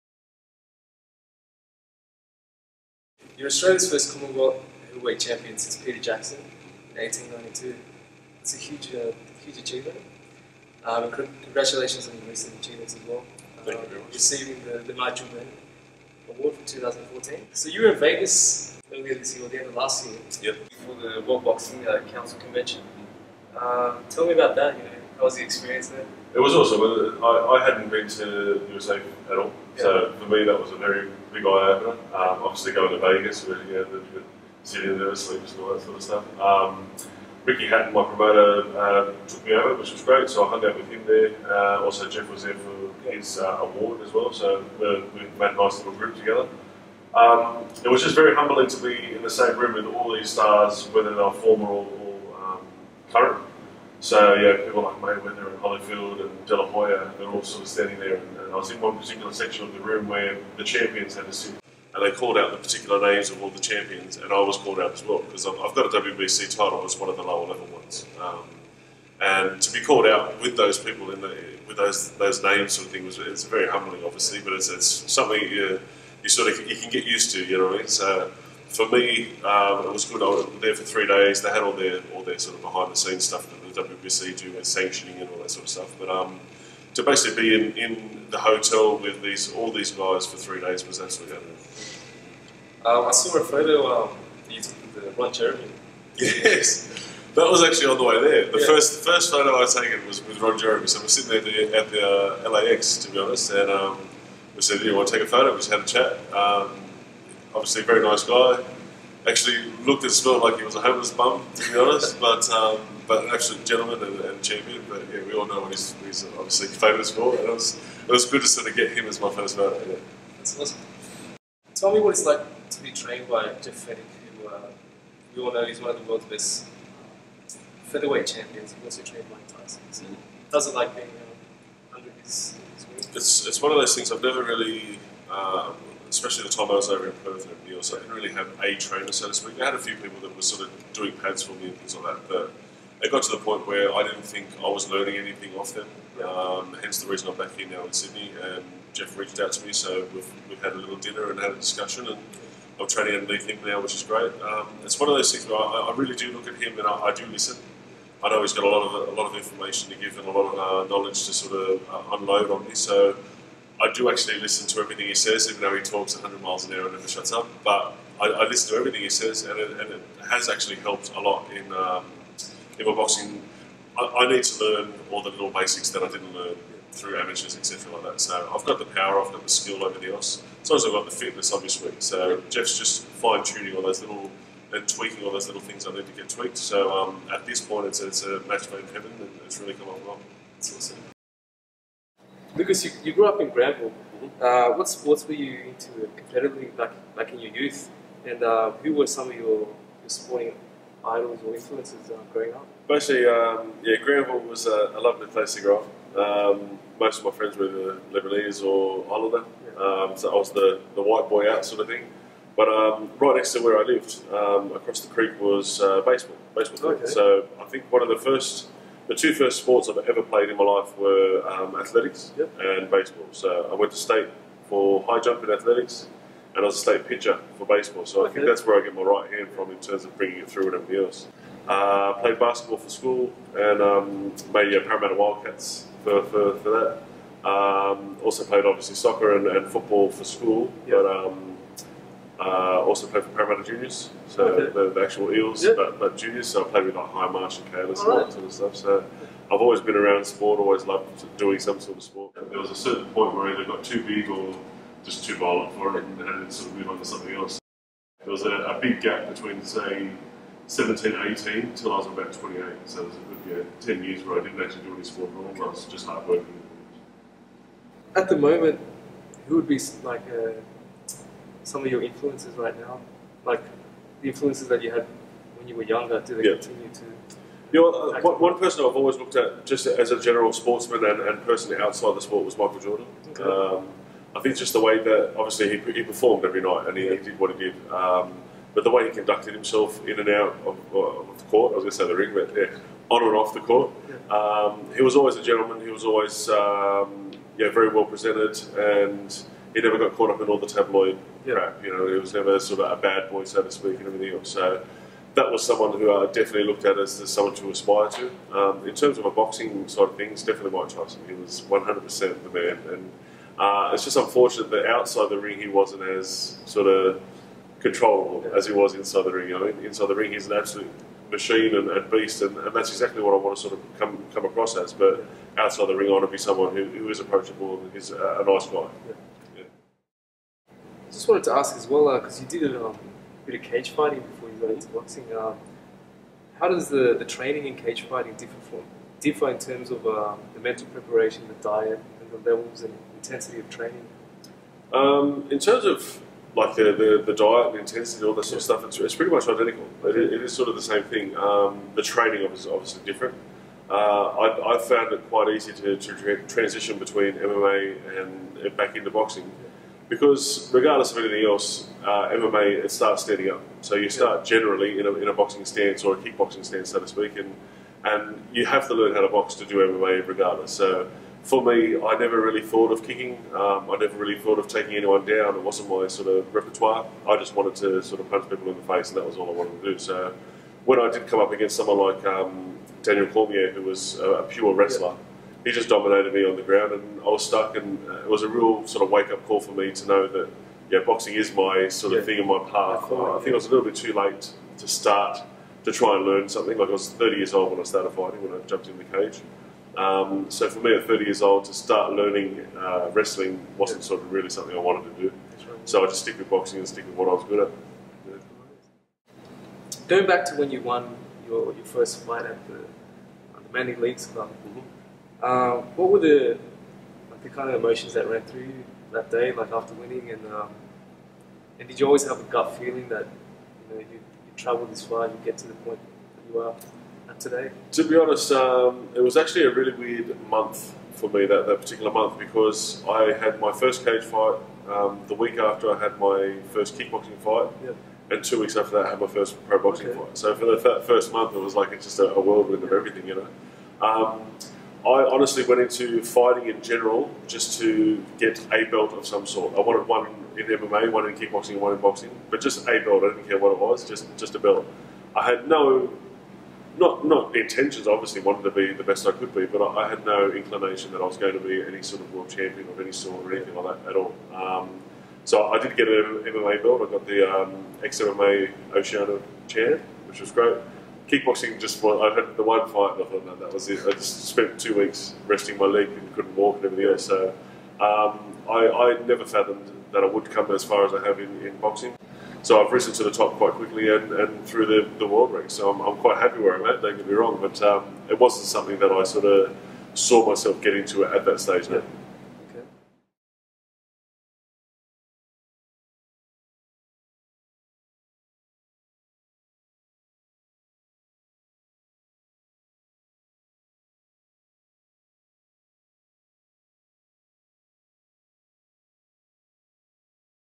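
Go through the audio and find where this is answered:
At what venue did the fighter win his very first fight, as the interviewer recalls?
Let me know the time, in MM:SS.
06:53.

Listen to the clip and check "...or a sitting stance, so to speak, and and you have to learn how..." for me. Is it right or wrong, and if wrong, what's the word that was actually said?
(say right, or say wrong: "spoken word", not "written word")
wrong: "kickboxing", not "sitting".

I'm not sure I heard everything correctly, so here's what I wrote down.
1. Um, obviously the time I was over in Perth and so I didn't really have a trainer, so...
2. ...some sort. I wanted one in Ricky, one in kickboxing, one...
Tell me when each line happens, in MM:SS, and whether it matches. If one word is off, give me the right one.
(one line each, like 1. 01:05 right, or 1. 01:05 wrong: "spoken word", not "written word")
1. 02:15 wrong: "especially", not "obviously"
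2. 07:29 wrong: "MMA", not "Ricky".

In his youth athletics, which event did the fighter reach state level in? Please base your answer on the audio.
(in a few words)
High jump.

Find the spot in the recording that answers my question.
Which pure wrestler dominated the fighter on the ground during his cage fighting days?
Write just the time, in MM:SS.
06:23.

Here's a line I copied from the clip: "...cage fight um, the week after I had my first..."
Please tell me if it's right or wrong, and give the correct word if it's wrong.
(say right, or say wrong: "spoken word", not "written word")
right.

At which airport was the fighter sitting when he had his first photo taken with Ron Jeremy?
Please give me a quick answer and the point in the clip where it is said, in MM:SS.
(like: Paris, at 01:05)
LAX, at 01:42.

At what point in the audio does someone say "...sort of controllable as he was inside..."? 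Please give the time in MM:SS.
05:16.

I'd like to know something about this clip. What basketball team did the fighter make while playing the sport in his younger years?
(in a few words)
Parramatta Wildcats.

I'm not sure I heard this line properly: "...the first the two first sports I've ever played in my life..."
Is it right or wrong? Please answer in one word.
right.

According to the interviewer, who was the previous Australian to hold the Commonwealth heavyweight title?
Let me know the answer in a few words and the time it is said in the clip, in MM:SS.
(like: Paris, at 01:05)
Peter Jackson, at 00:05.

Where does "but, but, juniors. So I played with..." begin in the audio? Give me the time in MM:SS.
04:05.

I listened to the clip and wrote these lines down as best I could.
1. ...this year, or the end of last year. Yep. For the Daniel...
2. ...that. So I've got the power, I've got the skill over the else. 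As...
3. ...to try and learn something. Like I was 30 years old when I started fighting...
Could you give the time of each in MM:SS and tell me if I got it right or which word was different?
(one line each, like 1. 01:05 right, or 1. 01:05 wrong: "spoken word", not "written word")
1. 00:19 wrong: "World", not "Daniel"
2. 02:58 right
3. 06:35 right.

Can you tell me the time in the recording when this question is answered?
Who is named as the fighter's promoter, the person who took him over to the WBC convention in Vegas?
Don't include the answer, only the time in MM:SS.
00:37.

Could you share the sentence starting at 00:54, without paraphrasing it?
So yeah, people like Mayweather and Holyfield and De La Hoya, they're all sort of standing there.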